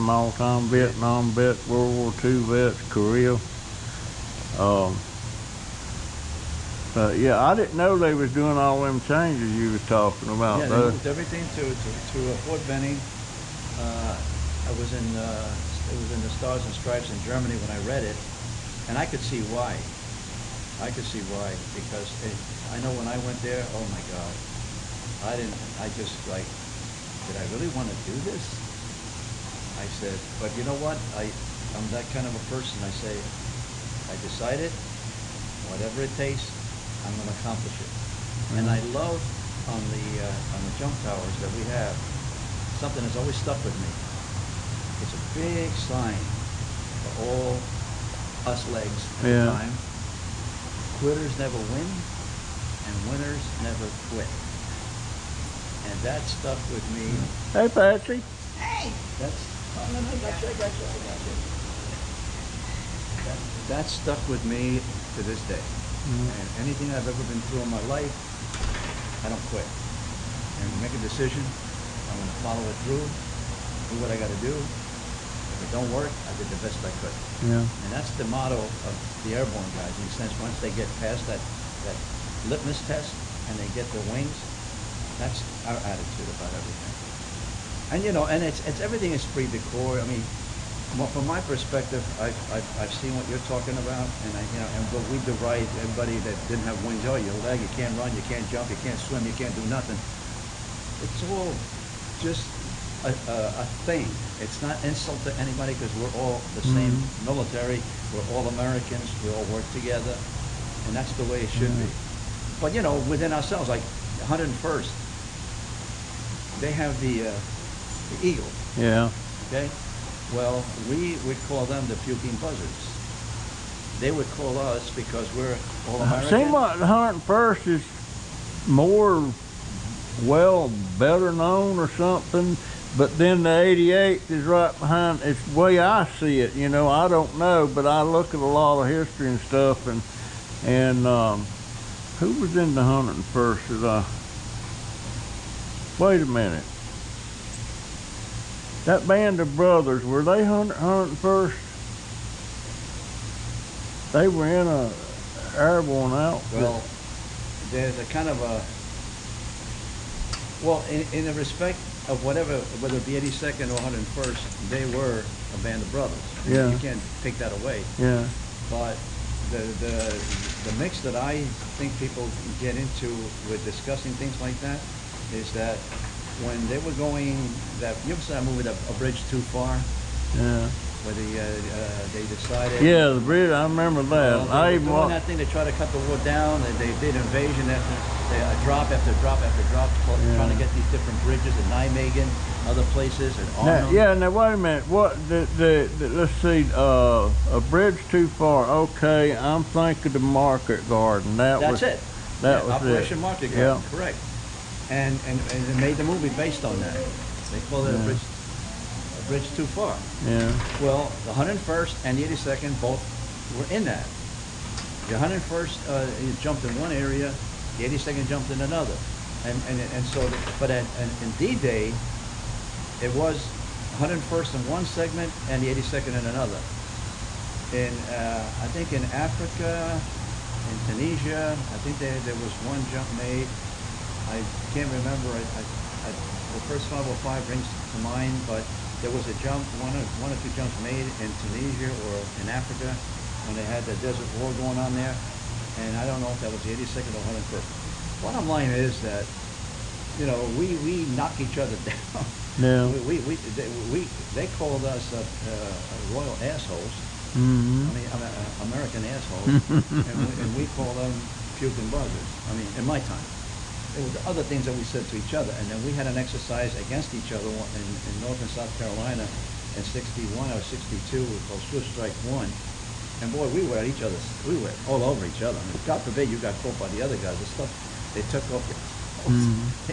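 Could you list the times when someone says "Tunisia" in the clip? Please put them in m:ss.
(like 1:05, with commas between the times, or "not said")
3:50, 4:01.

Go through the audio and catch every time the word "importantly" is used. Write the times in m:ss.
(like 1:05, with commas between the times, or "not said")
not said.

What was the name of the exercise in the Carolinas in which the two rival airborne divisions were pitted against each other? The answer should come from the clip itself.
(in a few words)
Swift Strike 1.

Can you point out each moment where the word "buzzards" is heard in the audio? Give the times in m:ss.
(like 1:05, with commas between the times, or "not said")
2:02, 4:21.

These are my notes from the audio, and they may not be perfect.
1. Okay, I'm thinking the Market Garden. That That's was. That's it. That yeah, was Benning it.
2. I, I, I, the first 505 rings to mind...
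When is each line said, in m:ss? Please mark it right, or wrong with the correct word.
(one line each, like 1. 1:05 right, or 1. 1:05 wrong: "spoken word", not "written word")
1. 3:18 wrong: "Operation", not "Benning"
2. 3:55 right.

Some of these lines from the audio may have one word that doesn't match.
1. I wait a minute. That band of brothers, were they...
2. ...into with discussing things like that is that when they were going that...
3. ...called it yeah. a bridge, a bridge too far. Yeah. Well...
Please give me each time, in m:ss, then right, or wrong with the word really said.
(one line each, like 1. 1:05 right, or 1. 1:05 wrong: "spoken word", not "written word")
1. 2:25 right
2. 2:52 right
3. 3:27 right.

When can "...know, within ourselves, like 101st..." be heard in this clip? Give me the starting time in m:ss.
1:52.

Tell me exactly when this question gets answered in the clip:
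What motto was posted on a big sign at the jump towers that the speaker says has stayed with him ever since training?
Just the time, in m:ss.
0:51.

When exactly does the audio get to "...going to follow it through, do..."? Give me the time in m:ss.
1:12.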